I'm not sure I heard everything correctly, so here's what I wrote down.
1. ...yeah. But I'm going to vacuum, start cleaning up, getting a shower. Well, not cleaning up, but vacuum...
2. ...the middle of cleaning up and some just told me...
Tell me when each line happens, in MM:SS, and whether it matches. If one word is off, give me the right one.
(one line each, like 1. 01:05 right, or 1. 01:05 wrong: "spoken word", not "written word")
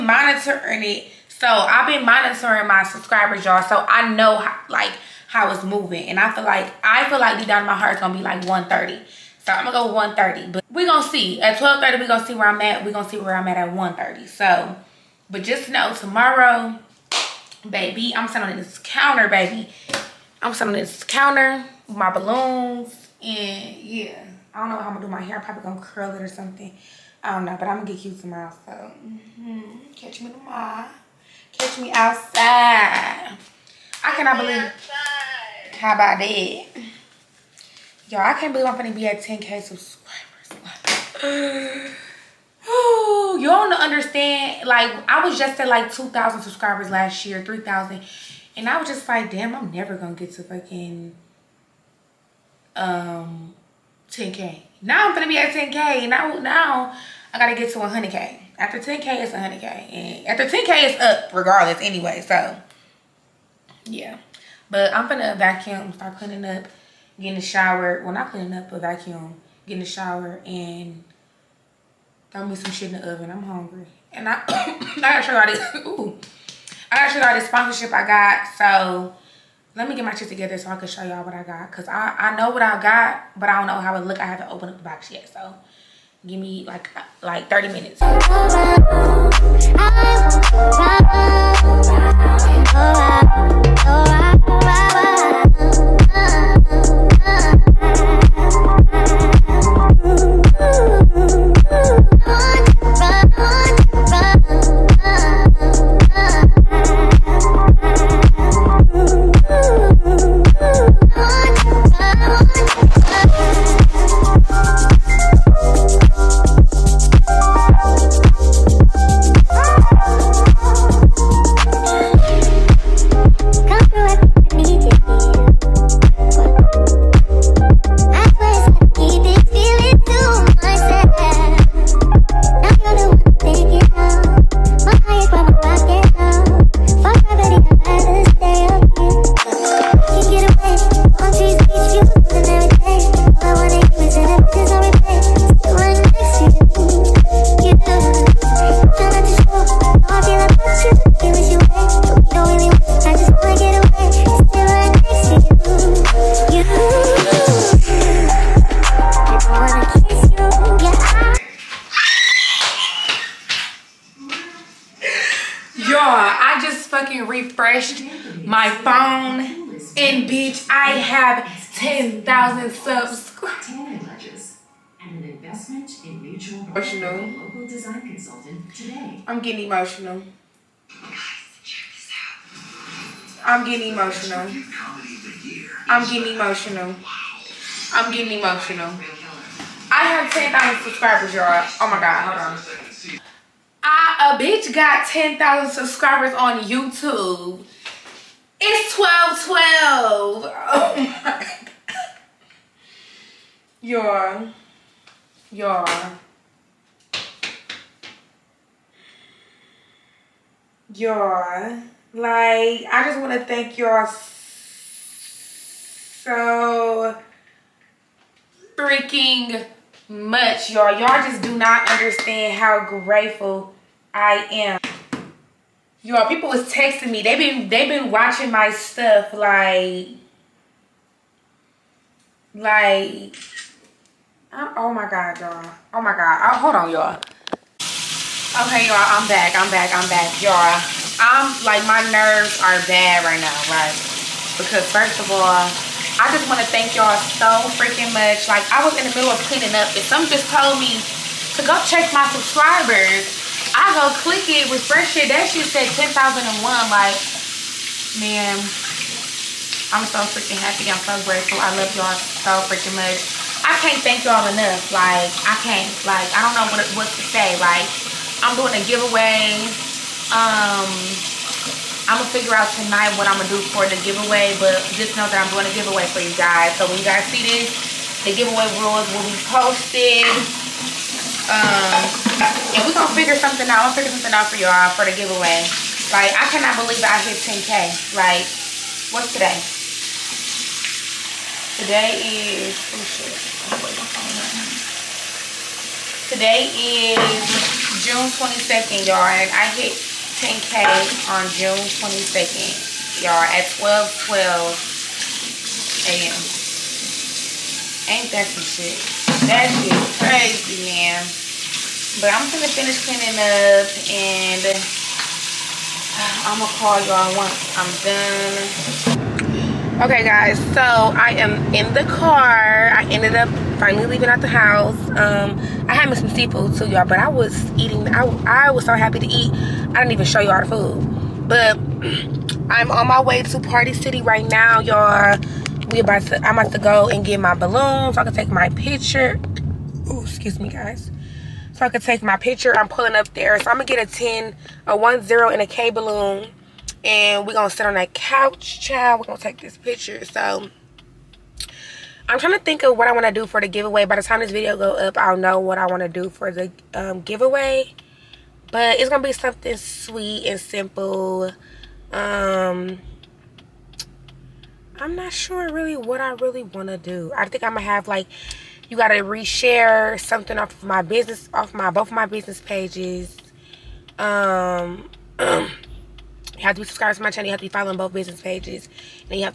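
1. 01:03 right
2. 04:09 right.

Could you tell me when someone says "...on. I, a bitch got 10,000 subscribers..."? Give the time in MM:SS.
03:12.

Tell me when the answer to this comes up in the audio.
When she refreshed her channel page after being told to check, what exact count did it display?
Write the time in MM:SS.
04:15.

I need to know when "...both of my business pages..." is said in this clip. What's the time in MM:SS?
06:11.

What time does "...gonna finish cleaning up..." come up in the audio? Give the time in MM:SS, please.
05:12.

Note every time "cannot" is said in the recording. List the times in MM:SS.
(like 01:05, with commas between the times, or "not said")
00:34, 04:46.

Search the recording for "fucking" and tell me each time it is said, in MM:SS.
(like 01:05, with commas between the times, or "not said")
00:50.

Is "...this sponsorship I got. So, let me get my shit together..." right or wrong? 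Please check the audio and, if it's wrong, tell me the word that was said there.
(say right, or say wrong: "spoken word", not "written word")
right.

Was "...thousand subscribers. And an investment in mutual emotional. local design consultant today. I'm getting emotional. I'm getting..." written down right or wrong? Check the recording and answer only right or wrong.
right.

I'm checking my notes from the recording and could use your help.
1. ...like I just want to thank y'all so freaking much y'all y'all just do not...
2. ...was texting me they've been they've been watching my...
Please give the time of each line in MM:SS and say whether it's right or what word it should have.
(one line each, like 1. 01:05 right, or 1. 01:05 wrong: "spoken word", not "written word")
1. 03:32 right
2. 03:46 right.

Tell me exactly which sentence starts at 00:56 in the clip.
Now, now I gotta get to 100k.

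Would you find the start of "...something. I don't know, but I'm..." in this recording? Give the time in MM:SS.
00:26.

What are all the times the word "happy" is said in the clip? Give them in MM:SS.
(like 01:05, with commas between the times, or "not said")
04:20, 05:28.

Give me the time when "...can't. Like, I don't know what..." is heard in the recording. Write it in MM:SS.
04:25.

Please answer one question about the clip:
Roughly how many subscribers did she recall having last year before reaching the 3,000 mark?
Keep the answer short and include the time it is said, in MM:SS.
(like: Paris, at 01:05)
2,000, at 00:45.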